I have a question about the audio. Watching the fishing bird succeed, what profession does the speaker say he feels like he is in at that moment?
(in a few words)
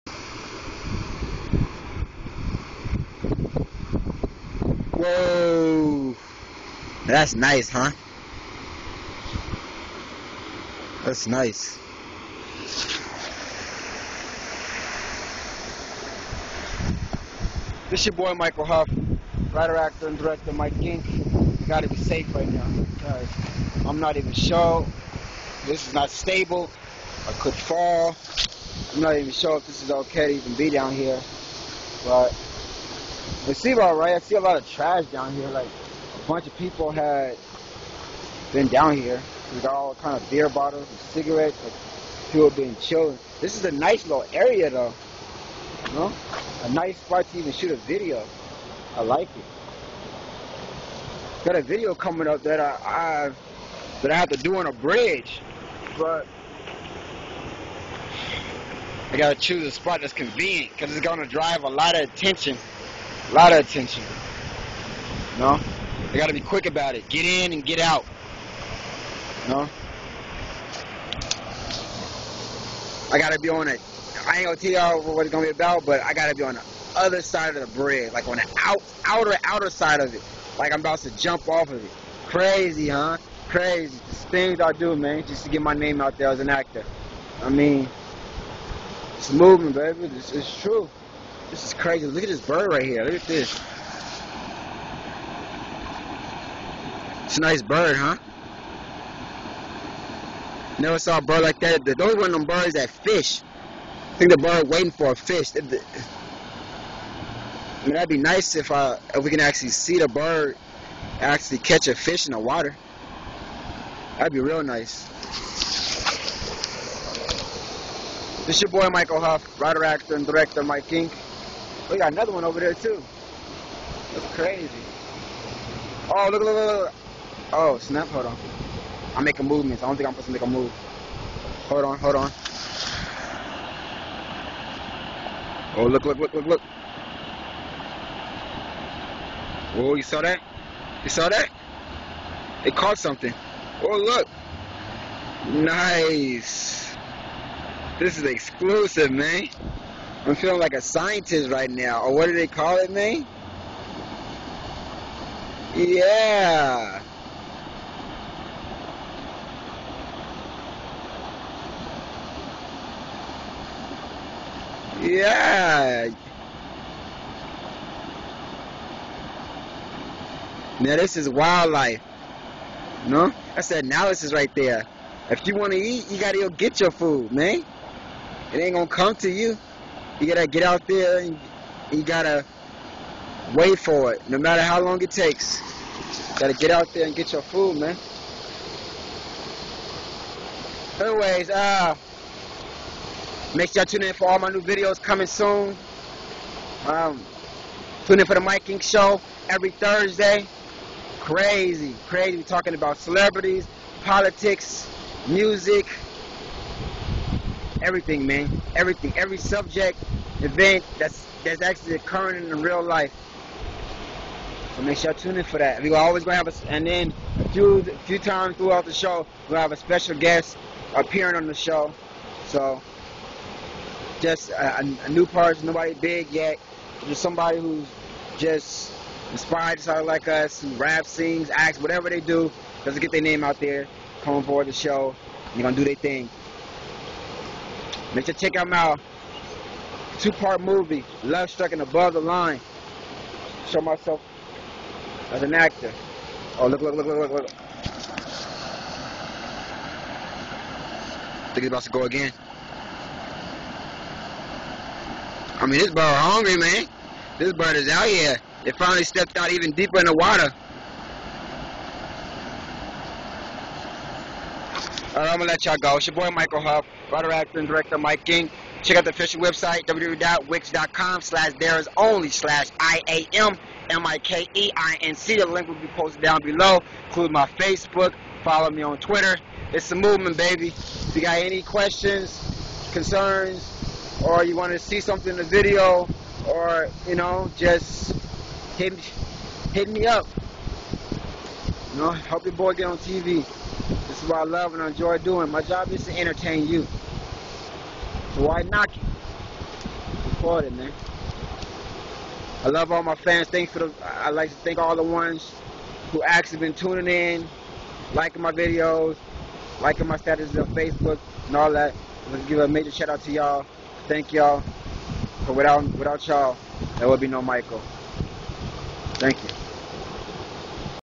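a scientist.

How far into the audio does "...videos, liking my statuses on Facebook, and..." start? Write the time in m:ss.
5:08.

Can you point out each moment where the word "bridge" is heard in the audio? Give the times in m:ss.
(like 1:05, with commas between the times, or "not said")
0:54, 1:17.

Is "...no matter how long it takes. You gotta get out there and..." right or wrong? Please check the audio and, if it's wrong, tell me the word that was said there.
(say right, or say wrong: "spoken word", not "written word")
right.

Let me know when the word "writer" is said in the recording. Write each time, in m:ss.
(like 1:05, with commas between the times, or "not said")
0:19, 1:59, 4:27.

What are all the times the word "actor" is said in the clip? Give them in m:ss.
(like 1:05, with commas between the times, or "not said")
0:19, 1:26, 1:59, 4:05, 4:27.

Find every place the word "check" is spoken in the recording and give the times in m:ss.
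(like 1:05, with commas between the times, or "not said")
3:58, 4:28.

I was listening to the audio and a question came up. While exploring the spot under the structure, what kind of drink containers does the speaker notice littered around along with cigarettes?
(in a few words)
beer bottles.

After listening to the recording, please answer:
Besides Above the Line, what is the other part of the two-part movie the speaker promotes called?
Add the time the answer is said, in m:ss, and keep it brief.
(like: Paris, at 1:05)
Love Struck, at 4:01.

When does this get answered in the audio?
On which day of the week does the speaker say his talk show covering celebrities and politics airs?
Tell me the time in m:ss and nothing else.
3:19.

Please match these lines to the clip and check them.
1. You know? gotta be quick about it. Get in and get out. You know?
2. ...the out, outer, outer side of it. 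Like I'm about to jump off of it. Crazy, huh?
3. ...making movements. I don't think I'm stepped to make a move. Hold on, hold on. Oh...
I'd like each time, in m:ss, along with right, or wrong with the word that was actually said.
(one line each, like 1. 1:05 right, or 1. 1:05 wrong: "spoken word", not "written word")
1. 1:05 right
2. 1:18 right
3. 2:09 wrong: "supposed", not "stepped".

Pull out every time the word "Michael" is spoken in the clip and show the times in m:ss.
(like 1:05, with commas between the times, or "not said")
0:18, 1:58, 4:26, 5:17.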